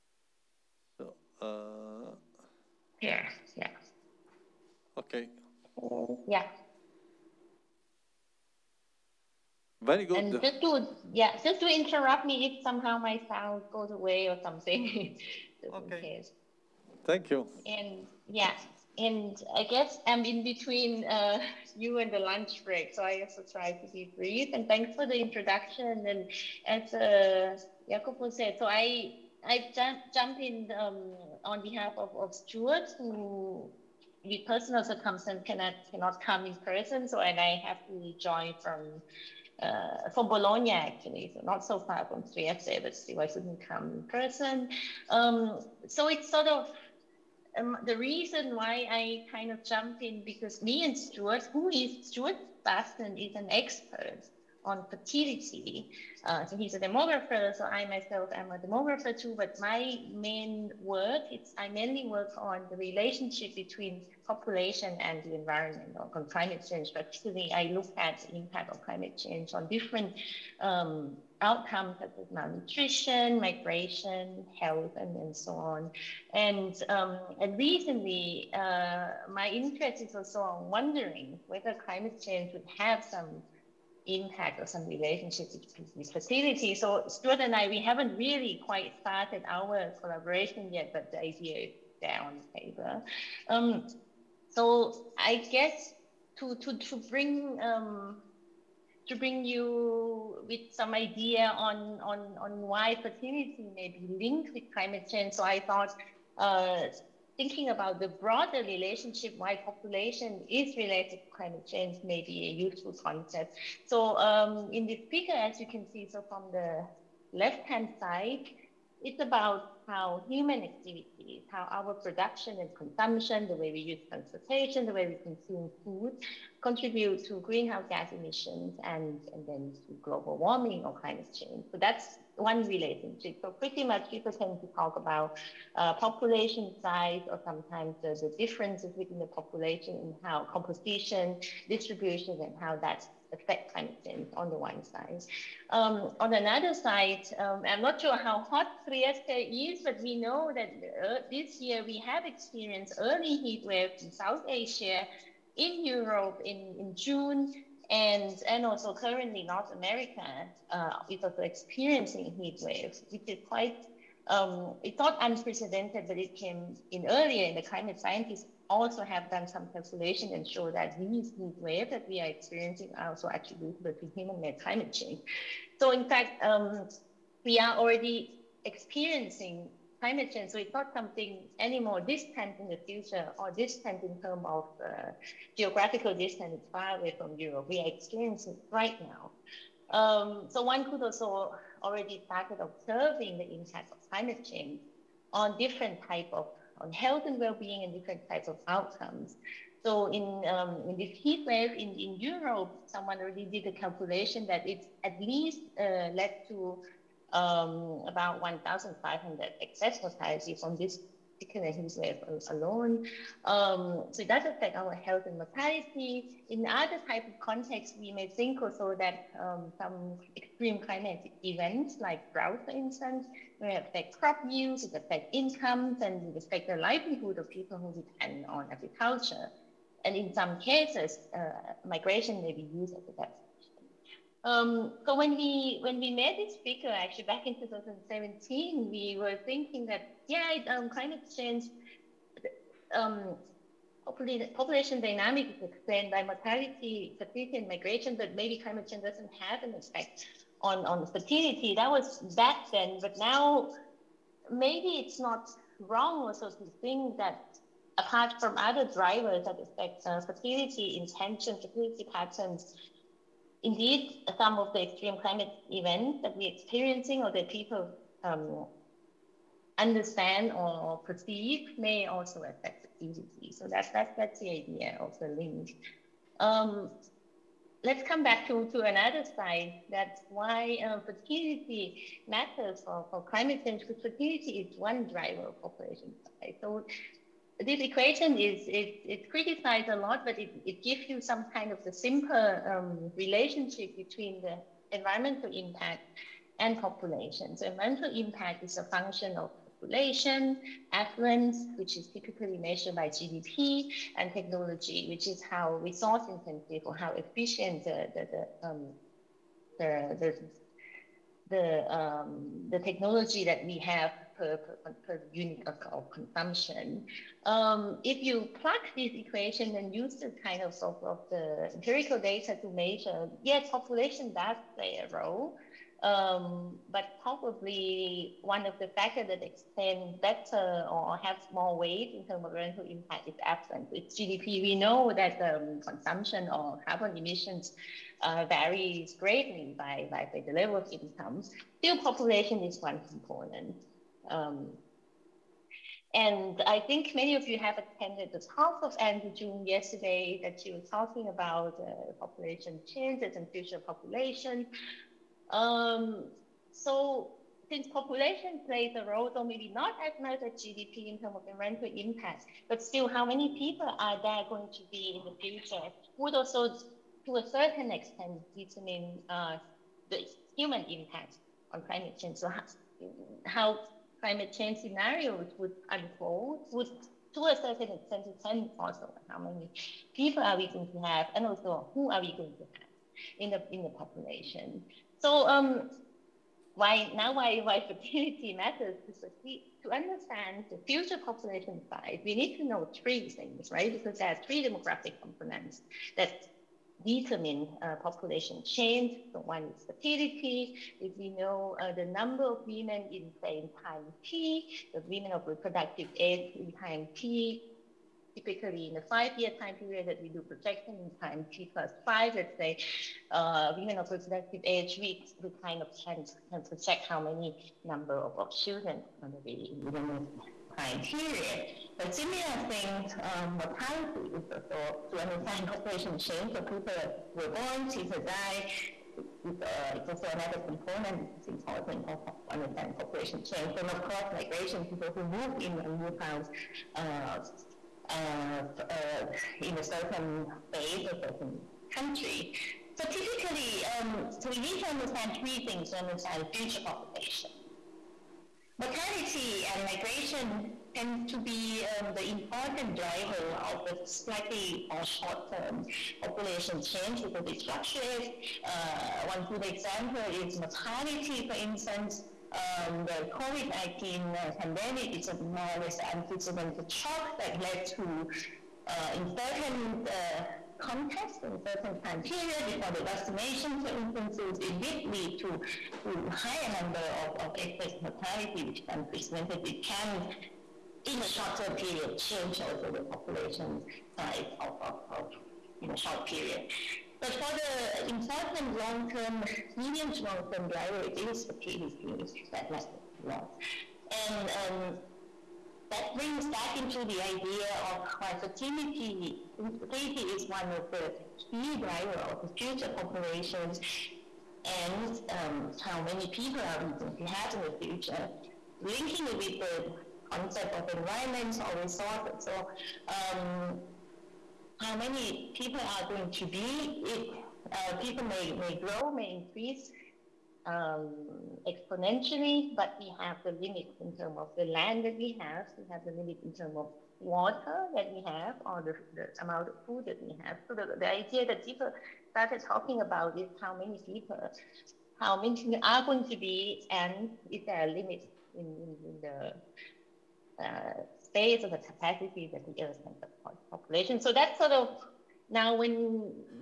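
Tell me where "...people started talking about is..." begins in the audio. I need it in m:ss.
8:51.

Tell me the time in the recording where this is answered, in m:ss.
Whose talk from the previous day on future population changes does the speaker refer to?
5:48.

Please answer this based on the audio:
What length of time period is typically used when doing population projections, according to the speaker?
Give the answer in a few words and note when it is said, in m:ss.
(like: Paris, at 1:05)
five-year, at 6:49.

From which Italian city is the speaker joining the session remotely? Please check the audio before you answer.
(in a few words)
Bologna.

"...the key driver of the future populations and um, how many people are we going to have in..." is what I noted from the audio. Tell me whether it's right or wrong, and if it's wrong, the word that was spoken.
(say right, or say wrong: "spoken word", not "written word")
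right.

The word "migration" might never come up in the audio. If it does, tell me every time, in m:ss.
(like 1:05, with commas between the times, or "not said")
1:13, 3:51, 4:07, 7:14, 7:29.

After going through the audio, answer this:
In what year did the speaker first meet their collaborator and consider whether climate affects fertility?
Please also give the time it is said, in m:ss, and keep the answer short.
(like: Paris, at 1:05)
2017, at 3:57.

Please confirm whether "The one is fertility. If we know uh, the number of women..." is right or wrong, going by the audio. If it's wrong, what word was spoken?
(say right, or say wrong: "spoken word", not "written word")
right.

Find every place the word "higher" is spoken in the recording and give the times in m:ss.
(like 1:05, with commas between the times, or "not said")
7:56.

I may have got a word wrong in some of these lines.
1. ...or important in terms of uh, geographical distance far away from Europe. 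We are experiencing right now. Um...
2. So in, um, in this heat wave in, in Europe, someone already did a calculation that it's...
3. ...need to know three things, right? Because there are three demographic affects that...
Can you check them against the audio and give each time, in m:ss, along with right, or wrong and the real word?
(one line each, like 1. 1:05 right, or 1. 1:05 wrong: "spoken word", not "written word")
1. 3:03 wrong: "distant", not "important"
2. 3:19 right
3. 6:32 wrong: "components", not "affects".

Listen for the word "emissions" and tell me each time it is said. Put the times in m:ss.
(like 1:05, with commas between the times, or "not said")
2:08, 5:37.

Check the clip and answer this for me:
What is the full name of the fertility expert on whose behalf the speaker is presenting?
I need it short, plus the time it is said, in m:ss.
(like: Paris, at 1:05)
Stuart Basten, at 0:52.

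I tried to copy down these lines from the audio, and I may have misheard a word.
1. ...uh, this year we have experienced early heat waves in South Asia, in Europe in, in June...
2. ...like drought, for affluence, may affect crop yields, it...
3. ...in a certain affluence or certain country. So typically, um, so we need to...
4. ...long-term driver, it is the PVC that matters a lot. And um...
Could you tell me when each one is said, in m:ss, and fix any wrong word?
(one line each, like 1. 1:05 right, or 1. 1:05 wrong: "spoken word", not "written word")
1. 2:31 right
2. 3:41 wrong: "instance", not "affluence"
3. 7:19 wrong: "space", not "affluence"
4. 8:10 right.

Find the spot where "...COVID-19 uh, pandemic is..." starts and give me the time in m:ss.
7:43.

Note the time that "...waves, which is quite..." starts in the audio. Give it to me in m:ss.
2:42.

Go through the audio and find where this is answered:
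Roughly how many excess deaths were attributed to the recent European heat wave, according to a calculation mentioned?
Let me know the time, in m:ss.
3:28.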